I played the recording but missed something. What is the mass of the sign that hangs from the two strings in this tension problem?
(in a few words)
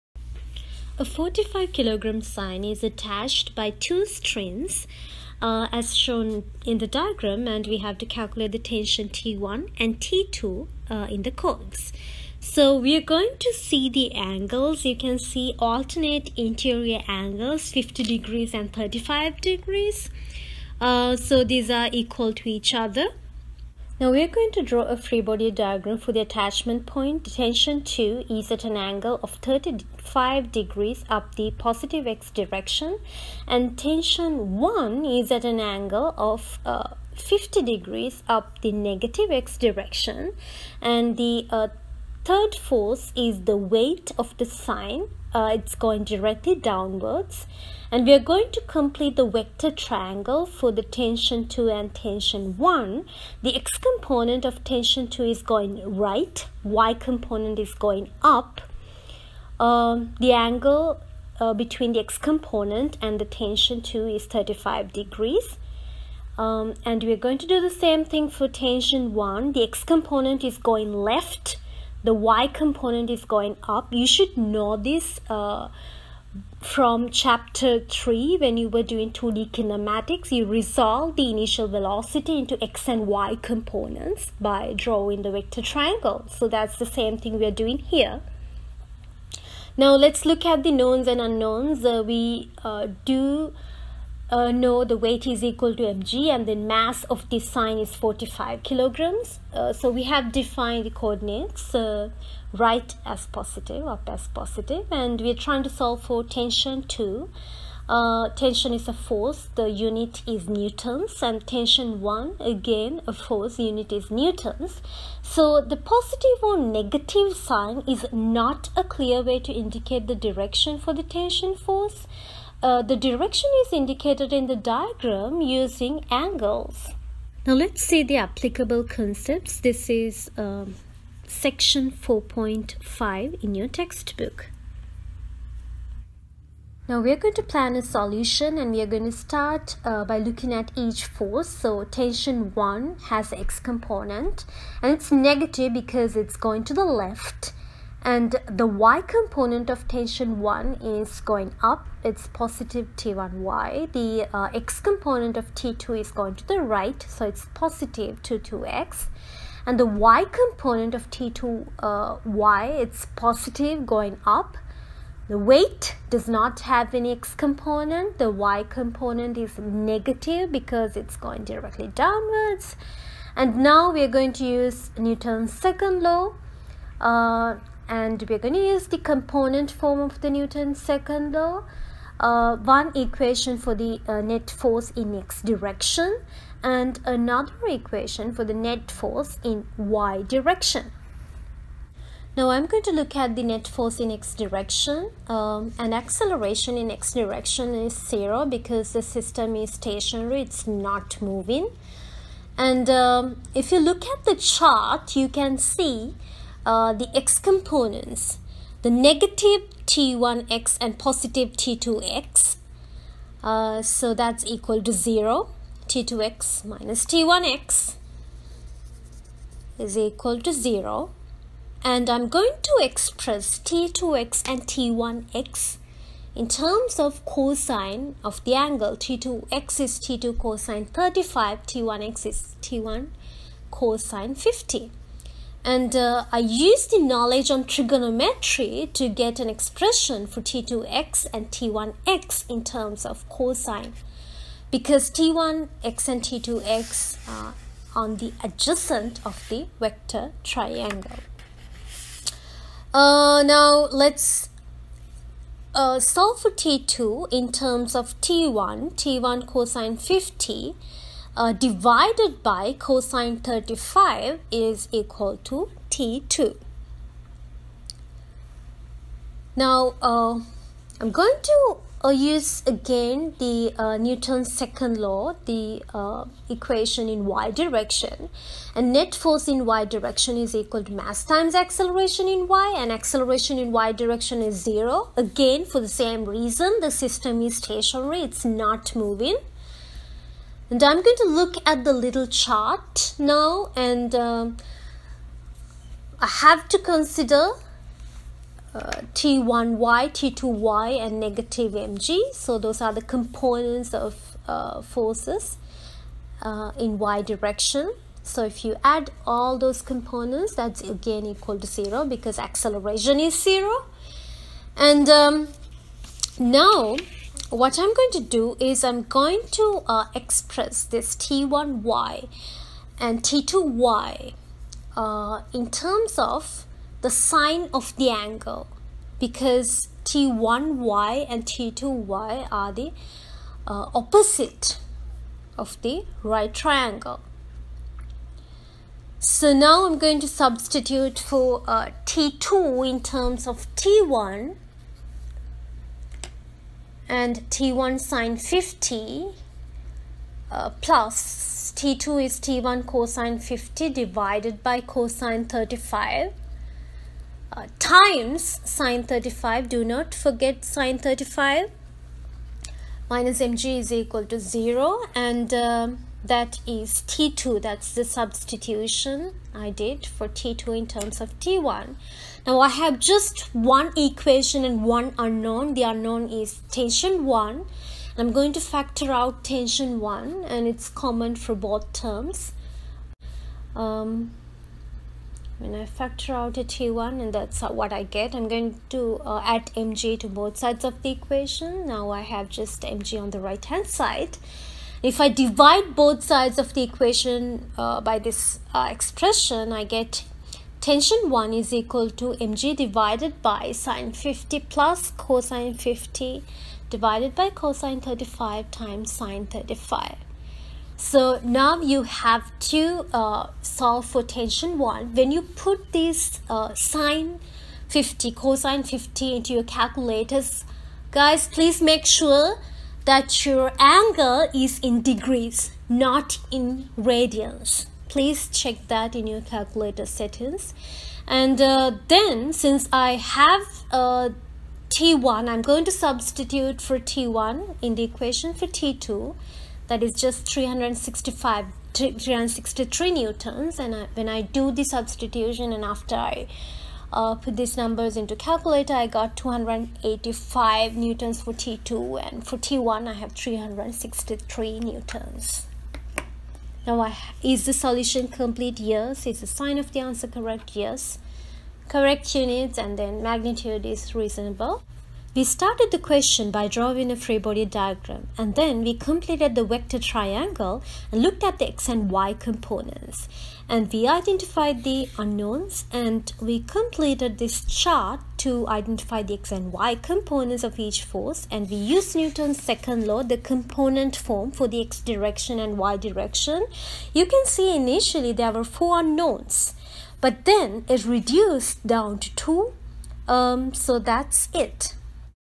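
45 kilograms.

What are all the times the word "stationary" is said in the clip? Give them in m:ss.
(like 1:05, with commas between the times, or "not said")
3:19, 4:47.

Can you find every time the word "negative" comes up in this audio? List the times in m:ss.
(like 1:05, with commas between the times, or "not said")
0:38, 1:56, 2:25, 2:49, 3:28, 5:01.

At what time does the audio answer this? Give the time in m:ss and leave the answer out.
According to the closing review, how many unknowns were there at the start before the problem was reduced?
8:08.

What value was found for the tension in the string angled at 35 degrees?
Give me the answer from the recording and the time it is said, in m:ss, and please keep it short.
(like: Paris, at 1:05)
285 newtons, at 7:29.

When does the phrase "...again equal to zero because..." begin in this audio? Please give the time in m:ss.
5:10.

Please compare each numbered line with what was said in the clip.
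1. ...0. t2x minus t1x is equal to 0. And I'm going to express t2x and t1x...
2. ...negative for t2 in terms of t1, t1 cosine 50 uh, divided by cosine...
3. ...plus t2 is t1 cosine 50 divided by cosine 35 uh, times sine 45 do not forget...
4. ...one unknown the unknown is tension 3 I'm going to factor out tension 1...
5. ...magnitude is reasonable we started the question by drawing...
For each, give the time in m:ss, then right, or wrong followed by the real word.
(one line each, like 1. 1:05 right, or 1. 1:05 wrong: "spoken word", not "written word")
1. 3:34 right
2. 4:15 wrong: "solve", not "negative"
3. 5:50 wrong: "35", not "45"
4. 6:14 wrong: "1", not "3"
5. 7:43 right.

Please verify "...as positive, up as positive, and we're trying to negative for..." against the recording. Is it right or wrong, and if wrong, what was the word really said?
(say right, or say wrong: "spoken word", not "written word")
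wrong: "solve", not "negative".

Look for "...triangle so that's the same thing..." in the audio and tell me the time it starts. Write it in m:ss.
1:25.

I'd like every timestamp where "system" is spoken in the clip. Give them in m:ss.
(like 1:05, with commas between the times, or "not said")
3:19, 4:46.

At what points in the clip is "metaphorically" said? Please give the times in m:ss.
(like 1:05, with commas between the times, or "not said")
not said.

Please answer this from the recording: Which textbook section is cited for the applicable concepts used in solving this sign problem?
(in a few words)
4.5.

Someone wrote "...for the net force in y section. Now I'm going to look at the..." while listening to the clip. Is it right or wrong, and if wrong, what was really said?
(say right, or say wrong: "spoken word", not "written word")
wrong: "direction", not "section".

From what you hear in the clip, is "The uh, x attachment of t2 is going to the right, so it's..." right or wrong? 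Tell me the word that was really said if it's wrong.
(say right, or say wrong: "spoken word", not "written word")
wrong: "component", not "attachment".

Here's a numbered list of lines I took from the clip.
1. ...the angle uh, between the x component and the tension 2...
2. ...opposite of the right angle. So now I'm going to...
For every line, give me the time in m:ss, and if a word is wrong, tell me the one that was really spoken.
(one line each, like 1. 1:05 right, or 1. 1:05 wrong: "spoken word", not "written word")
1. 1:00 right
2. 5:33 wrong: "triangle", not "angle".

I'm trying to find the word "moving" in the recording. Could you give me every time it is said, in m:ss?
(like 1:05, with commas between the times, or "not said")
3:21, 4:48.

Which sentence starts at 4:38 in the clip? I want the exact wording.
And net force in y direction is equal to mass times acceleration in y and acceleration in y direction is zero.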